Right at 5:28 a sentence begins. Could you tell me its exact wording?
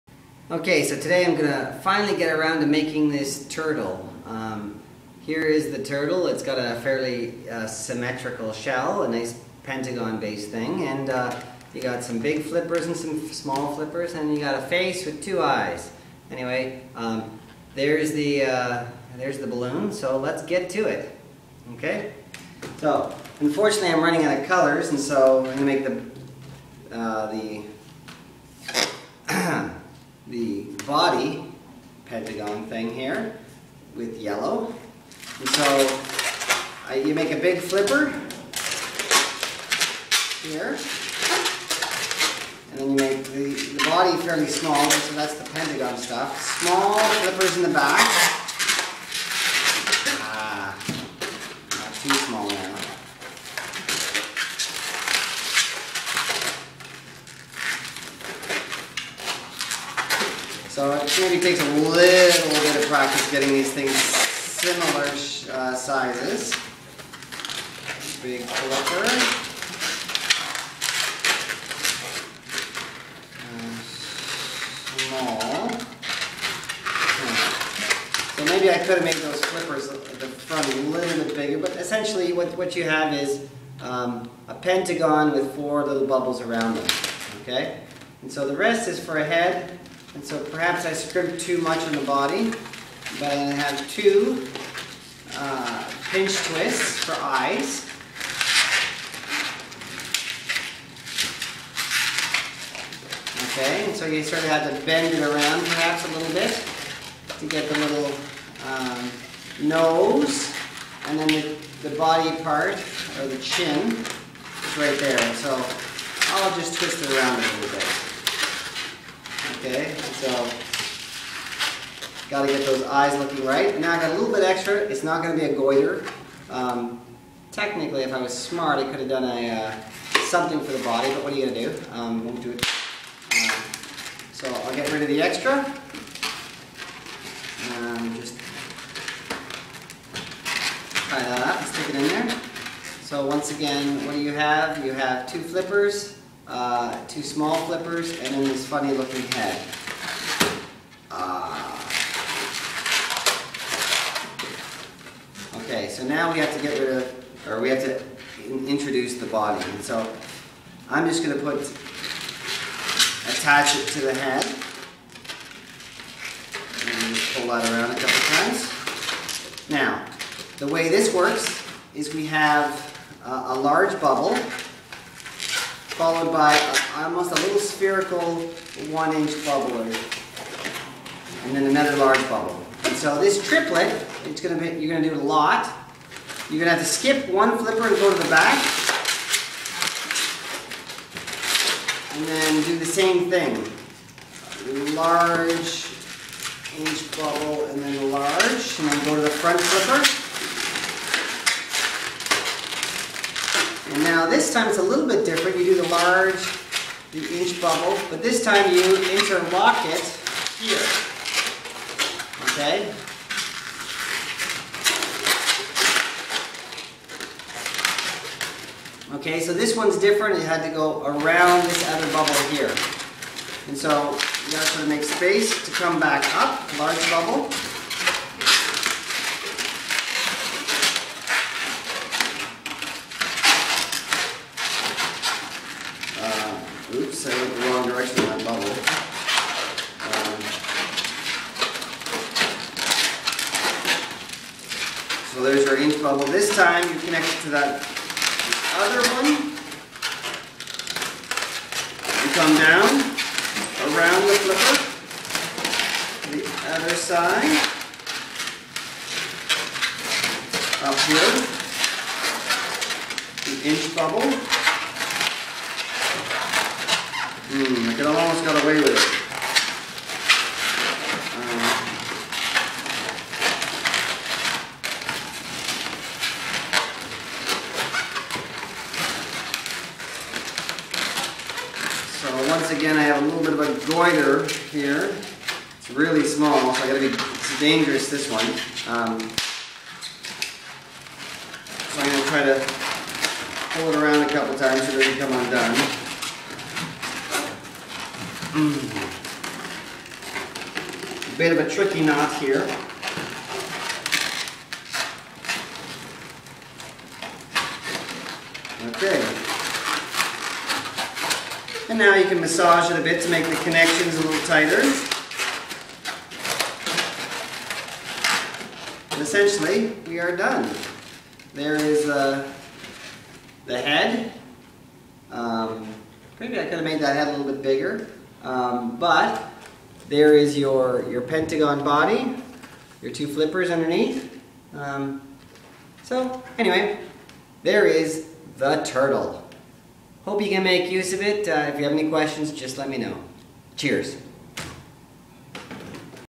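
Um, but there is your, your pentagon body, your two flippers underneath.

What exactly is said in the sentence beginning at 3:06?
You're gonna have to skip one flipper and go to the back.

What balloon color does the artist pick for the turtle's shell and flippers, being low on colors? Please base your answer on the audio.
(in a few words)
yellow.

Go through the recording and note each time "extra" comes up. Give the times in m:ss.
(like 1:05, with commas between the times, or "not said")
2:04, 2:15.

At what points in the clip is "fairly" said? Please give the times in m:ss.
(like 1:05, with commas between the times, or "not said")
0:06, 0:44.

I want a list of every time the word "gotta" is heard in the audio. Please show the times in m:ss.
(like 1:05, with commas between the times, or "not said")
3:44, 4:46.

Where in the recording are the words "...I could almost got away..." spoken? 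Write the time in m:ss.
4:27.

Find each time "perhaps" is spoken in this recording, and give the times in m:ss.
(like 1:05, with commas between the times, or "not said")
1:30, 1:45.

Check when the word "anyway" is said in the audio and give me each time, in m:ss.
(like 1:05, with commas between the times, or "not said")
0:16, 5:36.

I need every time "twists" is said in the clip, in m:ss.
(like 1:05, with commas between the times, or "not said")
1:36, 1:56.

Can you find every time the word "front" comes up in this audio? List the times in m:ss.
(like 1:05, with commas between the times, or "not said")
1:20, 3:19.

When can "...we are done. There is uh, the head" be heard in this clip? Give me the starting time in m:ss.
5:20.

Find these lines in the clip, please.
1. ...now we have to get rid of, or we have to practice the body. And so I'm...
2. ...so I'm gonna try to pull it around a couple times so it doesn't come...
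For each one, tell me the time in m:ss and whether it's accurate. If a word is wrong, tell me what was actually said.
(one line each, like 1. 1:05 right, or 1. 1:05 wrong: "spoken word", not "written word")
1. 2:36 wrong: "introduce", not "practice"
2. 4:51 right.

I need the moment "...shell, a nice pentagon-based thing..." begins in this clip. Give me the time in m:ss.
0:08.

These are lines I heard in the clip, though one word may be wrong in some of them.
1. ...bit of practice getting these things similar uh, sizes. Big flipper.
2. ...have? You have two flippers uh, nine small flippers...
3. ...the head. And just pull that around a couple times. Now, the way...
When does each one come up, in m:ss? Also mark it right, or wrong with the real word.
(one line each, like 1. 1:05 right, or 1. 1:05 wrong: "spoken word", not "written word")
1. 1:01 right
2. 2:24 wrong: "two", not "nine"
3. 2:44 right.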